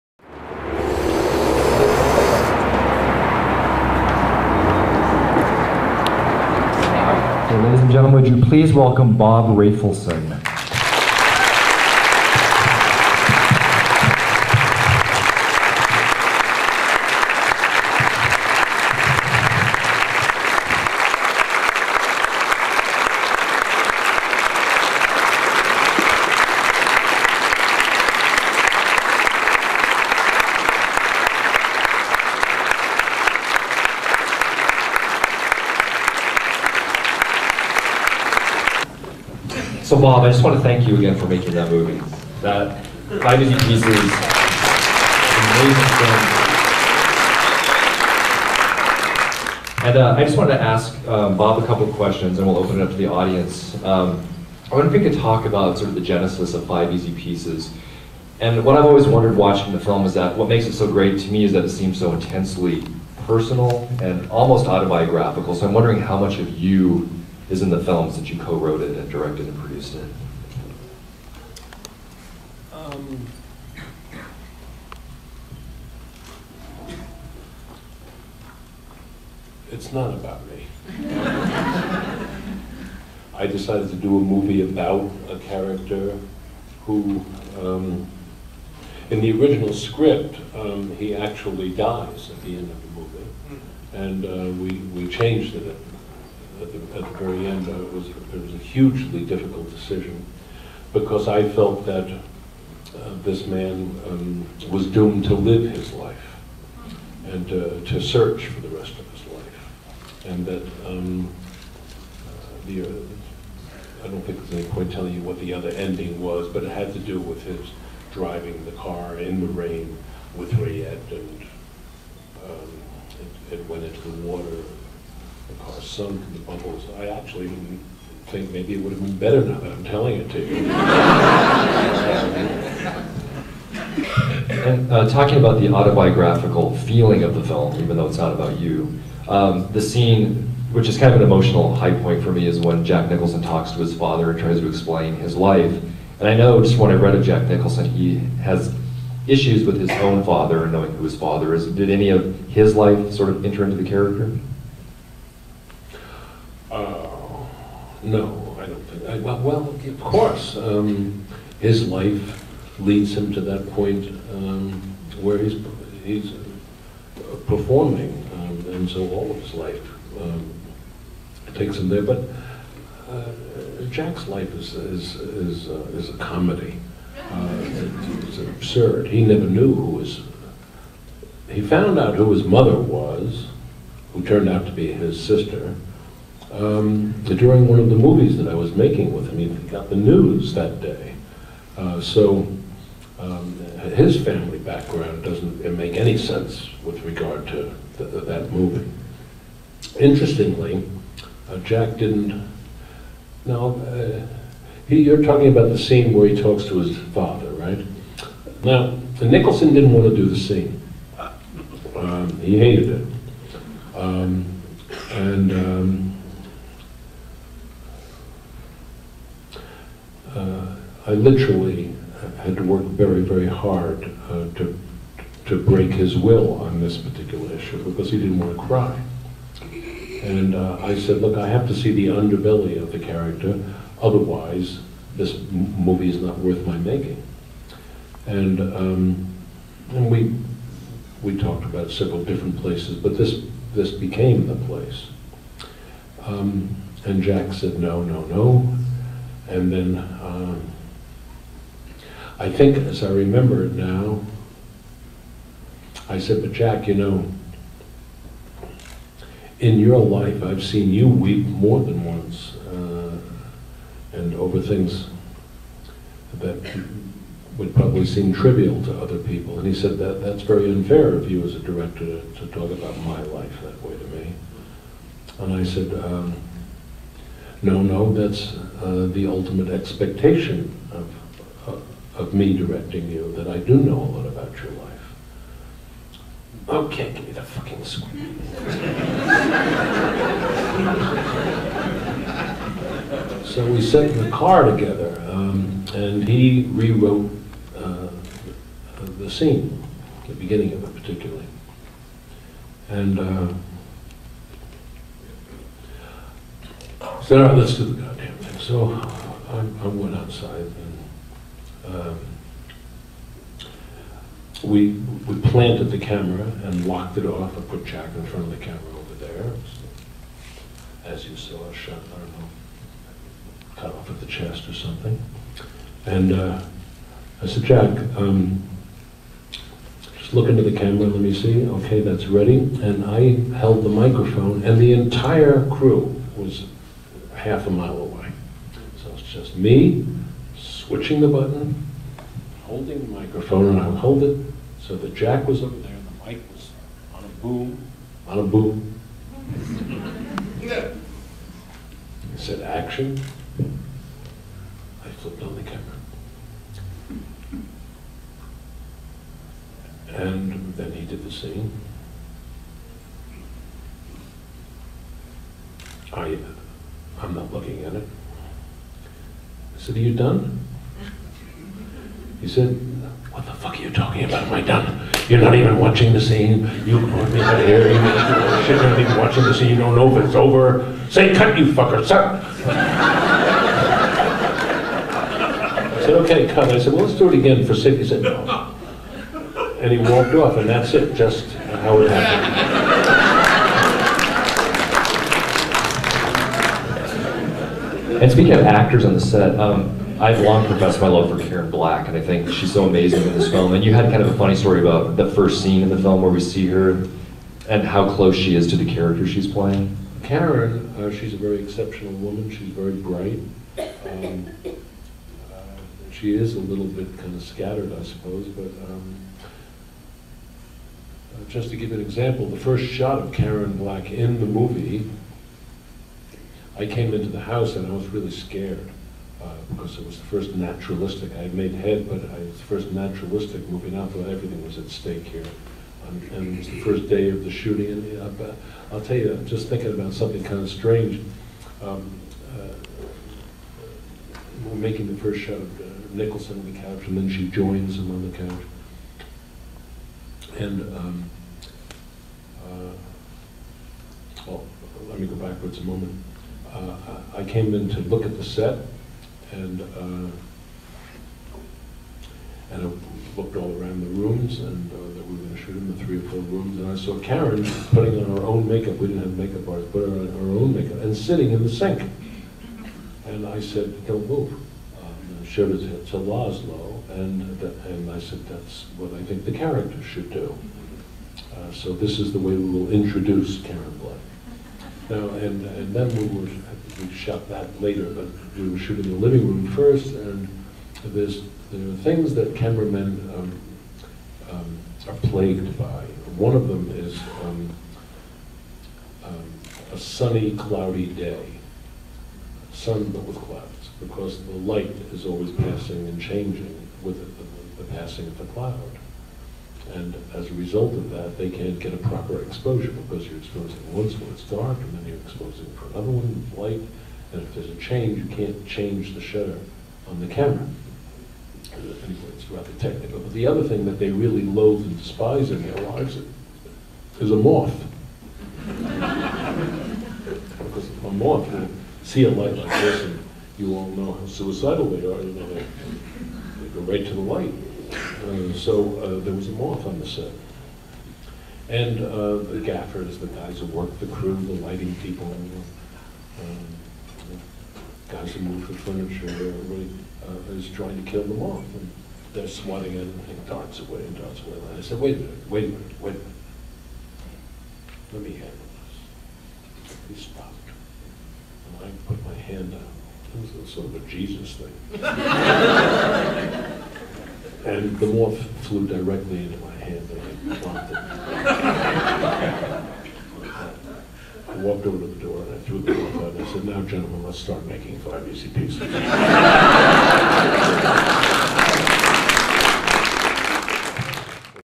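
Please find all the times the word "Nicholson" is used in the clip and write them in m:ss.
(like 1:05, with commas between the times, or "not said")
2:23, 2:27, 3:29, 7:26.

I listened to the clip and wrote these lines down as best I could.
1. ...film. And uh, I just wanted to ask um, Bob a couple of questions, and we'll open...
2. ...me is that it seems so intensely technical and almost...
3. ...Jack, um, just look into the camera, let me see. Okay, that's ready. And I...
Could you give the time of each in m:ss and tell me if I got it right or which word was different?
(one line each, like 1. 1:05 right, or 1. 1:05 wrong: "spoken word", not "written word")
1. 0:49 right
2. 1:01 wrong: "personal", not "technical"
3. 5:27 right.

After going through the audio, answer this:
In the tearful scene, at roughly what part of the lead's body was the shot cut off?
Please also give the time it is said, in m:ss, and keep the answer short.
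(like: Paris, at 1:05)
the chest, at 5:24.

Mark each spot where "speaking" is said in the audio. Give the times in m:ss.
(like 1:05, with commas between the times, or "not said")
6:38.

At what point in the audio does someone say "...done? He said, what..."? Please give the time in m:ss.
6:10.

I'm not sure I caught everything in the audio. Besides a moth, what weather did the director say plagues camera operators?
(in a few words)
a sunny, cloudy day.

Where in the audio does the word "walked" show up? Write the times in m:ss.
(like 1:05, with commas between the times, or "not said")
6:29, 9:34.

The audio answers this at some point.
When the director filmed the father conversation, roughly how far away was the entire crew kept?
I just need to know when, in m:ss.
5:37.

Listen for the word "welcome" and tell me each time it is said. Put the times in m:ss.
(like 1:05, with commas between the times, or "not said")
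0:08.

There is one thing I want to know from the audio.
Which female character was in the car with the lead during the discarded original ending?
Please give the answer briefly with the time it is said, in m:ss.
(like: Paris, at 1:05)
Rayette, at 2:00.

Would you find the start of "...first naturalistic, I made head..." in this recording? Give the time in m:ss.
7:10.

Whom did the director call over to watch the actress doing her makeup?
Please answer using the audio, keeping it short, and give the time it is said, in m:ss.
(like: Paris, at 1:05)
Laszlo, at 7:56.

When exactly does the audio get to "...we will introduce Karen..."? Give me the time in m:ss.
8:02.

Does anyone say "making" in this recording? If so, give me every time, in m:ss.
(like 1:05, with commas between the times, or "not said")
0:41, 3:08, 3:56, 7:24, 9:37.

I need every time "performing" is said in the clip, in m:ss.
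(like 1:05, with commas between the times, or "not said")
2:47.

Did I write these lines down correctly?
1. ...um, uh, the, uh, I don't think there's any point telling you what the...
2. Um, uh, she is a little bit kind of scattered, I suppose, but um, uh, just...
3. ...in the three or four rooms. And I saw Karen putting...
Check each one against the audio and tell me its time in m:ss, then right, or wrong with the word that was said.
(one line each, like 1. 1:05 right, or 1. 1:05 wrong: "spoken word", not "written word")
1. 1:50 right
2. 6:53 right
3. 7:45 right.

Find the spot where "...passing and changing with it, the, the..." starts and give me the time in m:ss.
8:25.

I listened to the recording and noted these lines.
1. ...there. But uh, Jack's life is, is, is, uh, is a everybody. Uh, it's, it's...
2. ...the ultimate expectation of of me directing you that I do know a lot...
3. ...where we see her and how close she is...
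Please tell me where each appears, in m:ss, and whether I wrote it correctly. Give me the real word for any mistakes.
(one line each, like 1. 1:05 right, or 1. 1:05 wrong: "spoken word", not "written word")
1. 2:51 wrong: "comedy", not "everybody"
2. 4:39 right
3. 6:46 right.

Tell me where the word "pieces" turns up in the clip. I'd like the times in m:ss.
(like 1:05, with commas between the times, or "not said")
0:43, 0:57, 9:38.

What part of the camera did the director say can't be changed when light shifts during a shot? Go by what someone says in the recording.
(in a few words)
the shutter.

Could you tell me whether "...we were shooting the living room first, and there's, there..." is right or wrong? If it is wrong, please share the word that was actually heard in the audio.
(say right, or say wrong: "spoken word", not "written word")
right.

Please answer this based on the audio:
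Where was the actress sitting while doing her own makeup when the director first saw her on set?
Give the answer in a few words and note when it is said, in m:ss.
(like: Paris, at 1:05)
in the sink, at 7:51.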